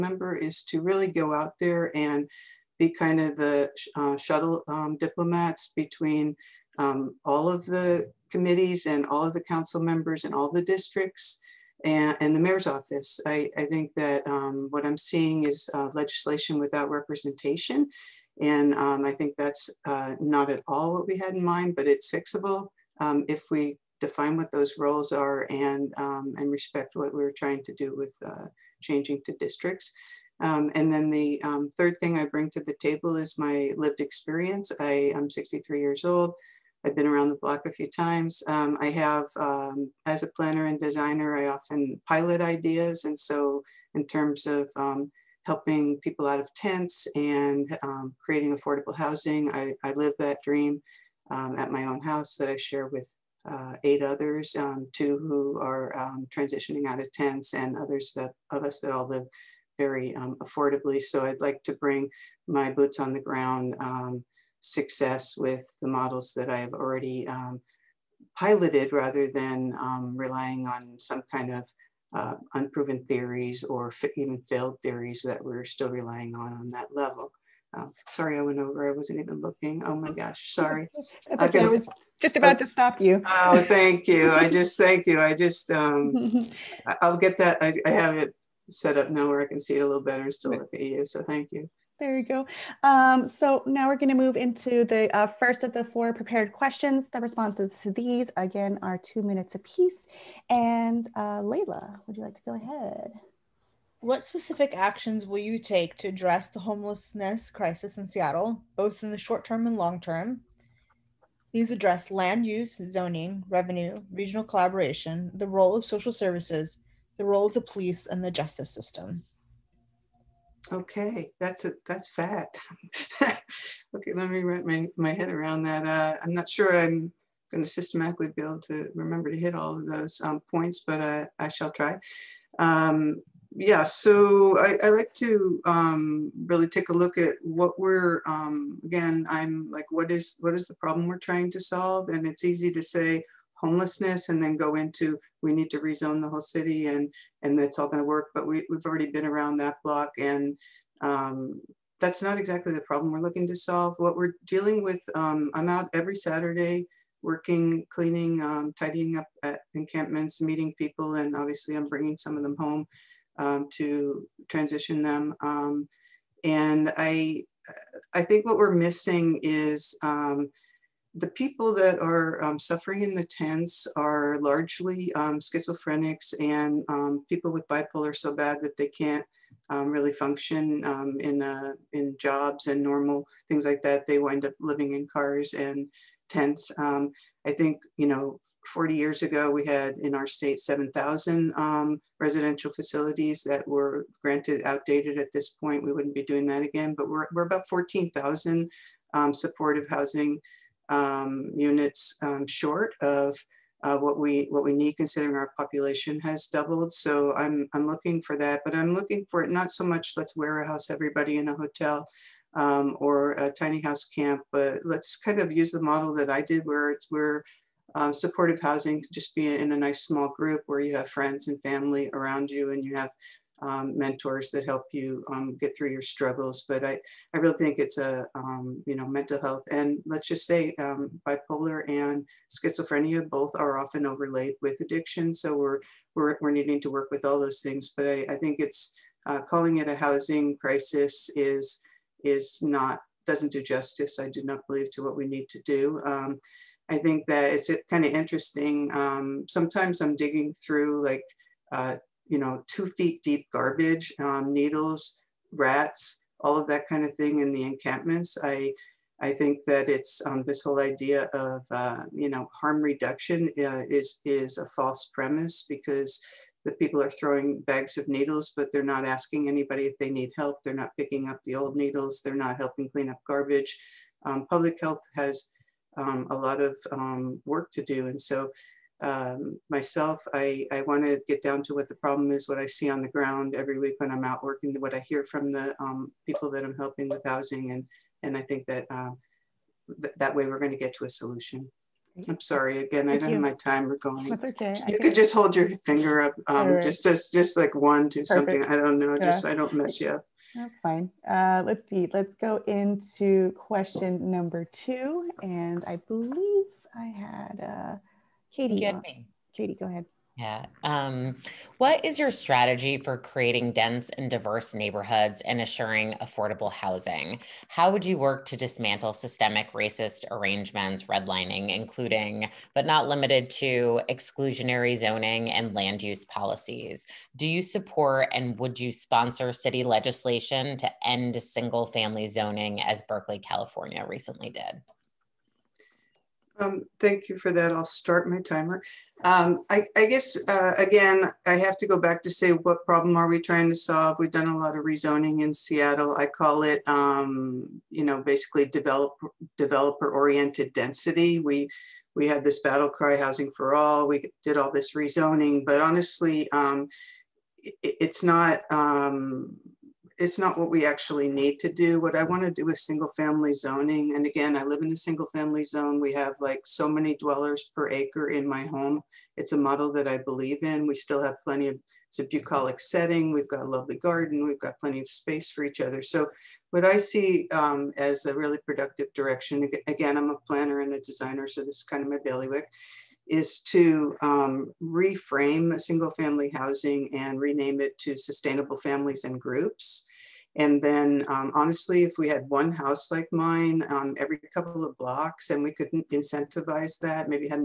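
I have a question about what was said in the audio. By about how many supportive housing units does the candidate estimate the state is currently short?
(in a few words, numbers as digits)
14,000.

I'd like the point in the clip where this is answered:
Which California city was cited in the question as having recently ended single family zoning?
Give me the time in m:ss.
5:33.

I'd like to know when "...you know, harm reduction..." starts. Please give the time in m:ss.
4:22.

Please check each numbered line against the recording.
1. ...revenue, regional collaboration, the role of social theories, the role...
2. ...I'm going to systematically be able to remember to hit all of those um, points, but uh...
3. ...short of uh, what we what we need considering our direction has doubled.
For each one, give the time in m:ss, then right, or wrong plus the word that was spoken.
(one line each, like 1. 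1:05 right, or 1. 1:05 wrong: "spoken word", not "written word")
1. 1:53 wrong: "services", not "theories"
2. 2:06 right
3. 3:22 wrong: "population", not "direction".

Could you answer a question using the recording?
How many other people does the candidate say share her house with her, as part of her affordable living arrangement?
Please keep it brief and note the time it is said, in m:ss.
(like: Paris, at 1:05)
8, at 0:53.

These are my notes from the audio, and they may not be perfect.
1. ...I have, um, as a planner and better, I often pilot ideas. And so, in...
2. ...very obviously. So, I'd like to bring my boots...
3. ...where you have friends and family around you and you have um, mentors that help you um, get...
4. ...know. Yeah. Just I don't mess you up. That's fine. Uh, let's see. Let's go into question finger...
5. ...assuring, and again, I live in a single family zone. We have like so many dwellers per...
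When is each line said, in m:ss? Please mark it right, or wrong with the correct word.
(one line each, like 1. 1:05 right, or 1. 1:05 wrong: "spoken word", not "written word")
1. 0:38 wrong: "designer", not "better"
2. 0:59 wrong: "affordably", not "obviously"
3. 3:40 right
4. 4:58 wrong: "number", not "finger"
5. 6:03 wrong: "zoning", not "assuring".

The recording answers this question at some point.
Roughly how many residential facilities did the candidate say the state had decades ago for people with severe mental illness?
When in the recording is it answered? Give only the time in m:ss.
3:10.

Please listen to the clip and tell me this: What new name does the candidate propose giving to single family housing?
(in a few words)
sustainable families and groups.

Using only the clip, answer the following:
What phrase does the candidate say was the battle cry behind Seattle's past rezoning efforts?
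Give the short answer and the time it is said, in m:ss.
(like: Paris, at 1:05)
housing for all, at 5:53.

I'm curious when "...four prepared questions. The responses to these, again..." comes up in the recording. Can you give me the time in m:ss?
1:35.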